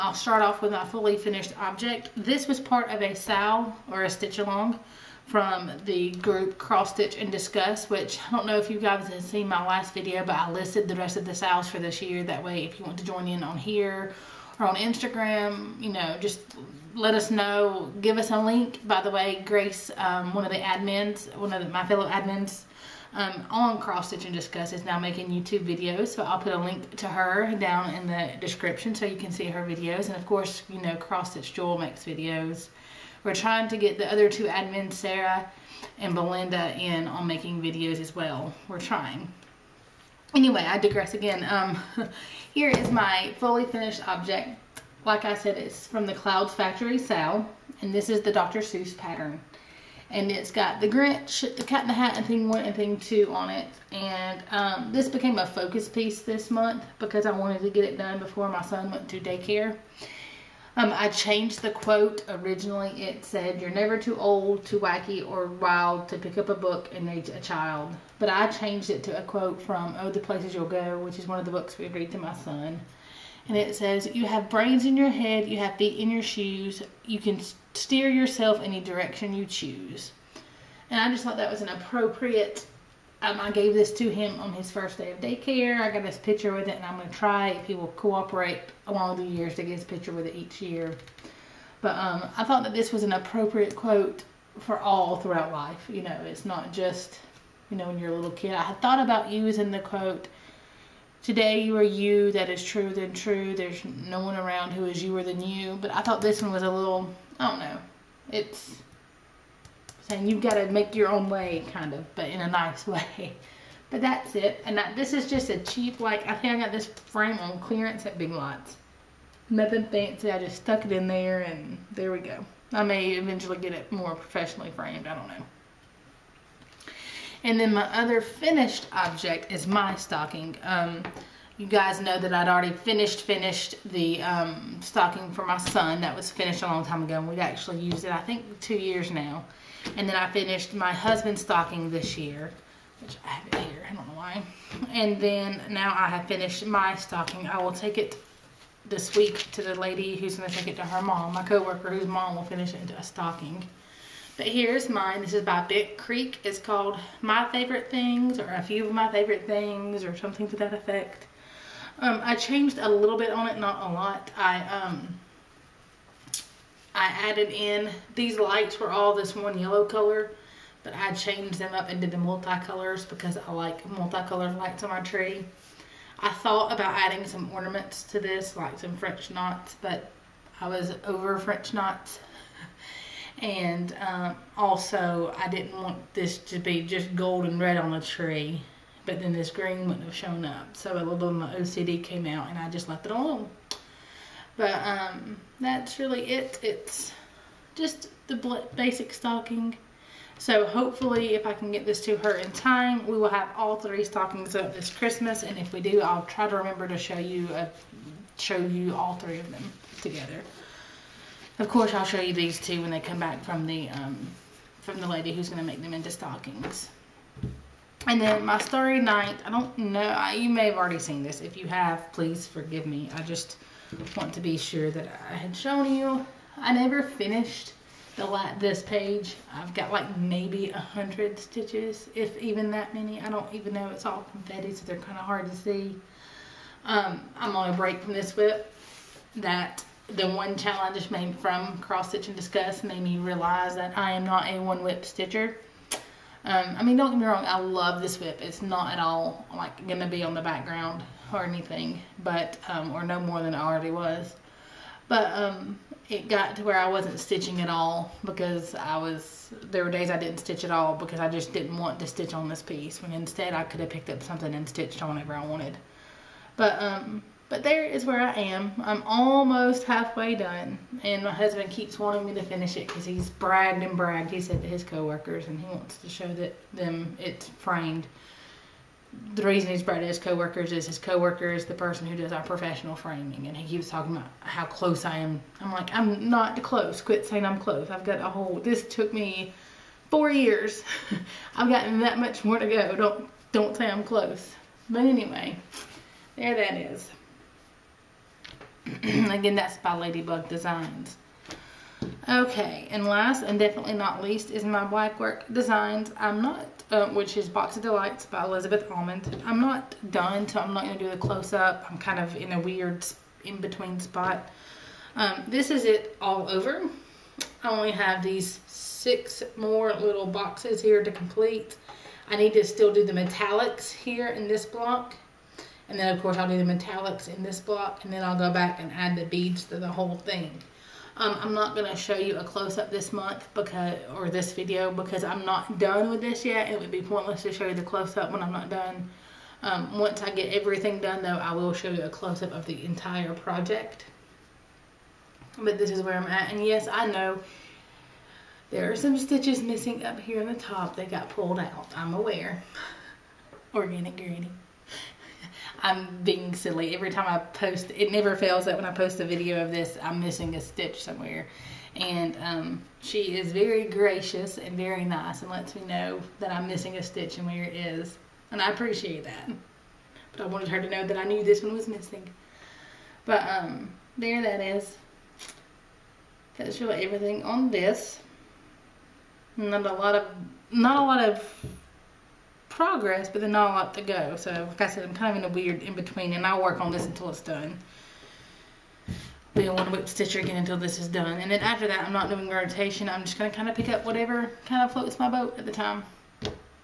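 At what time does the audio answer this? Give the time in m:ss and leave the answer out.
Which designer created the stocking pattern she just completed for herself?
2:35.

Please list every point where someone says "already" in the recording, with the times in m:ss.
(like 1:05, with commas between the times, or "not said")
2:12, 3:40, 4:13.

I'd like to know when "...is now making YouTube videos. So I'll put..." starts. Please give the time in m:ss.
0:24.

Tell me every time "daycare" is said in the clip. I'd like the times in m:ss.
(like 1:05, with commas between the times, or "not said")
0:59, 1:25.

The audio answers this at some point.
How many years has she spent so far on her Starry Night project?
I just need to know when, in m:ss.
4:50.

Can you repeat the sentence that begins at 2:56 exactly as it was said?
I thought about adding some ornaments to this, like some French knots, but I was over French knots.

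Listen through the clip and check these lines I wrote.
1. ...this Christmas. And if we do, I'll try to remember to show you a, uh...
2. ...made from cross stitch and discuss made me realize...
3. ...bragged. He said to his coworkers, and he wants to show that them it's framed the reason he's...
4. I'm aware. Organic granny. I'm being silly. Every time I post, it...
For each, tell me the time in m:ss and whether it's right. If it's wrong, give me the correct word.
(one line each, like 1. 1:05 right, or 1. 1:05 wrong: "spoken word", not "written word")
1. 3:24 right
2. 4:01 right
3. 4:33 right
4. 5:51 right.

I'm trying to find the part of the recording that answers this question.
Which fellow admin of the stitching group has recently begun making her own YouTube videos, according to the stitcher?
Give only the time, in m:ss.
0:19.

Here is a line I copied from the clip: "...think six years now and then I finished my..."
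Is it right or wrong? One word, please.
wrong.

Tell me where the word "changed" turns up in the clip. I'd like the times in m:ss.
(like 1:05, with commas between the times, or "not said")
1:01, 1:08, 2:42, 2:51.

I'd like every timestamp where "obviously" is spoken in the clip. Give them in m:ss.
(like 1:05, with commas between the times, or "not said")
not said.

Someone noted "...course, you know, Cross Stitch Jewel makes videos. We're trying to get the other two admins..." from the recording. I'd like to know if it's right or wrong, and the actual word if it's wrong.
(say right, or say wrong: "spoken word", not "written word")
right.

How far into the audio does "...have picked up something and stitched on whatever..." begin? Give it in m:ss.
4:23.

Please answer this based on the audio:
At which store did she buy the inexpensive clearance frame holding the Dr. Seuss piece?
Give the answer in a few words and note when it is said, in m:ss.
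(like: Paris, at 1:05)
Big Lots, at 1:58.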